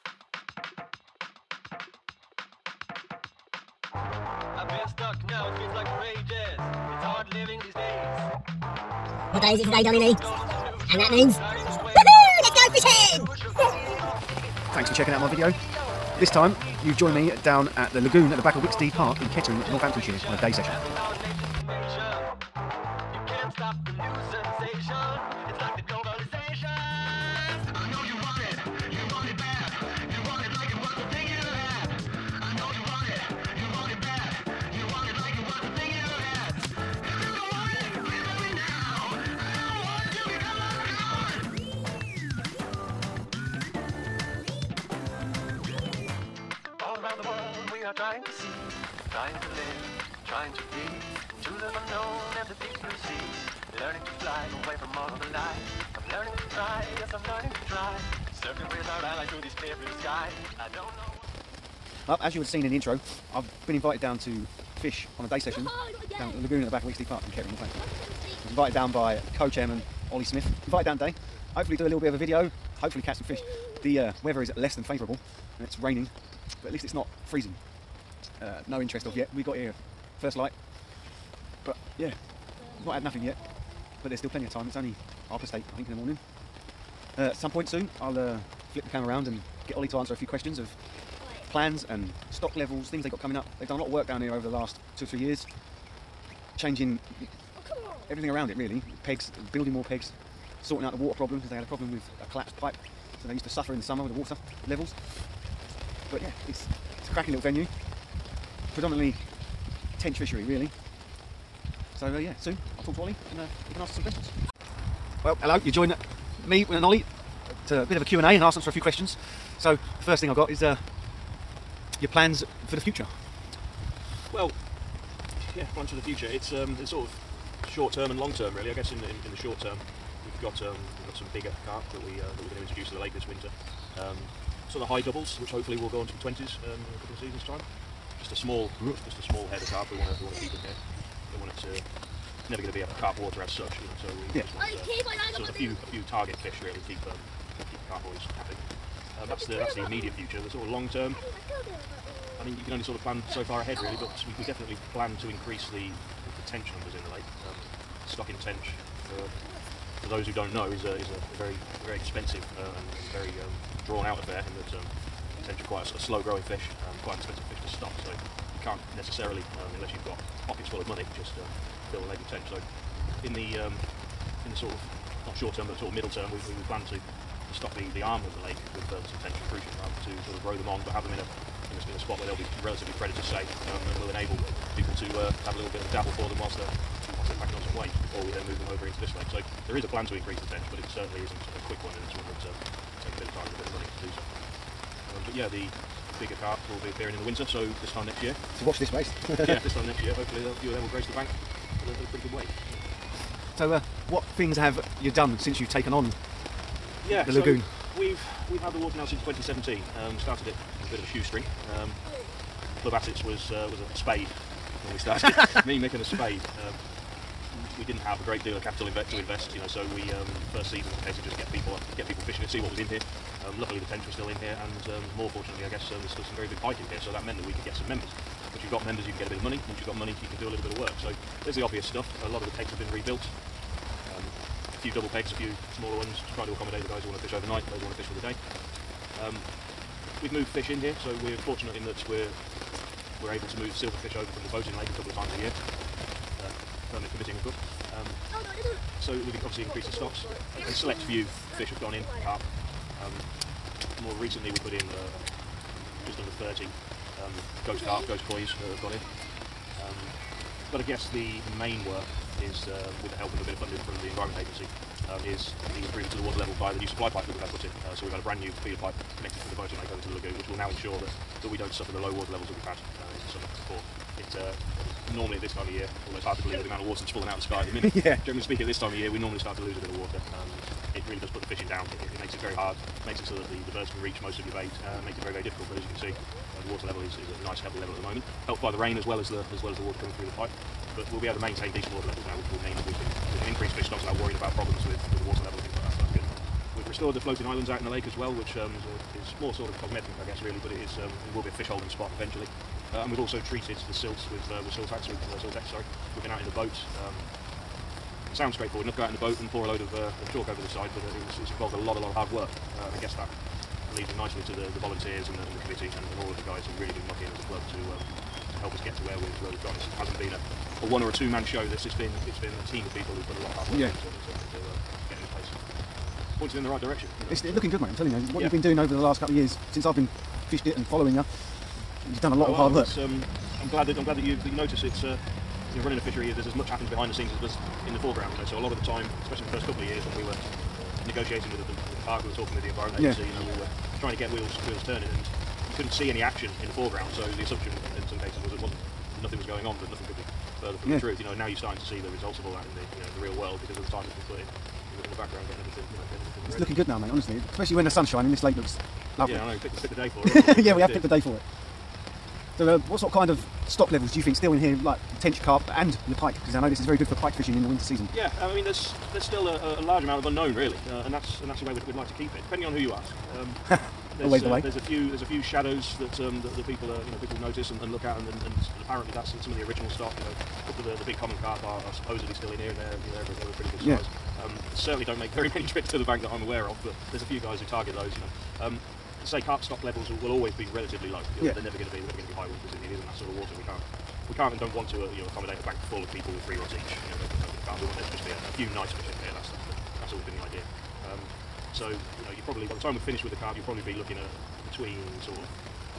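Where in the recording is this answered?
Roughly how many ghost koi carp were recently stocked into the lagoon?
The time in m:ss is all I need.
4:16.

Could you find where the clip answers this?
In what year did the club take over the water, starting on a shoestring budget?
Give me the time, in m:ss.
3:29.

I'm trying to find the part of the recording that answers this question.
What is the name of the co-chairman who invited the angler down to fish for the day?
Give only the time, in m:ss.
1:10.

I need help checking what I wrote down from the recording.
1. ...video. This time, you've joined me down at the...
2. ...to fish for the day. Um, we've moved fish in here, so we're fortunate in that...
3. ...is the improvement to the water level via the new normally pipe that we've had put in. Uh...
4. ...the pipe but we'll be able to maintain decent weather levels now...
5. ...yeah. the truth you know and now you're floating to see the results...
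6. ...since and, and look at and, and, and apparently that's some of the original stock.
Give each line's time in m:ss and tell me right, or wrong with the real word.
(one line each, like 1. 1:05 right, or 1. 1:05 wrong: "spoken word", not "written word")
1. 0:15 right
2. 3:57 right
3. 4:25 wrong: "supply", not "normally"
4. 4:50 wrong: "water", not "weather"
5. 5:50 wrong: "starting", not "floating"
6. 6:17 wrong: "notice", not "since".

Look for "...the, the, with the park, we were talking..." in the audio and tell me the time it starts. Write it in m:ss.
5:41.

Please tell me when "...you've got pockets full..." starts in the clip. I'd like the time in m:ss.
2:49.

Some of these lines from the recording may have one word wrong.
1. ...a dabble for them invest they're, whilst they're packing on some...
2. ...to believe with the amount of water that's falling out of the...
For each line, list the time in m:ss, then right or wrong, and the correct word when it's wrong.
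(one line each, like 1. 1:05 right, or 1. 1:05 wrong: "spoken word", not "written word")
1. 3:05 wrong: "whilst", not "invest"
2. 4:36 right.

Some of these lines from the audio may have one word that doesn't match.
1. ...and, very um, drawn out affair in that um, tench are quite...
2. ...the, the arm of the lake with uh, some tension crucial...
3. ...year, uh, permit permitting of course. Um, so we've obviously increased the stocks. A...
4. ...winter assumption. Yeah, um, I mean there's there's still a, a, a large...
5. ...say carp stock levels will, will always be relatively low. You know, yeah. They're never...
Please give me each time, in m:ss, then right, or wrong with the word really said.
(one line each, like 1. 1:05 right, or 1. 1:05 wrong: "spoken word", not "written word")
1. 2:42 right
2. 2:57 right
3. 4:05 right
4. 6:07 wrong: "season", not "assumption"
5. 6:29 right.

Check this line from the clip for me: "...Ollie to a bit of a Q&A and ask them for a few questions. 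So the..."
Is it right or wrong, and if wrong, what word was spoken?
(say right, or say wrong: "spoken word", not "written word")
right.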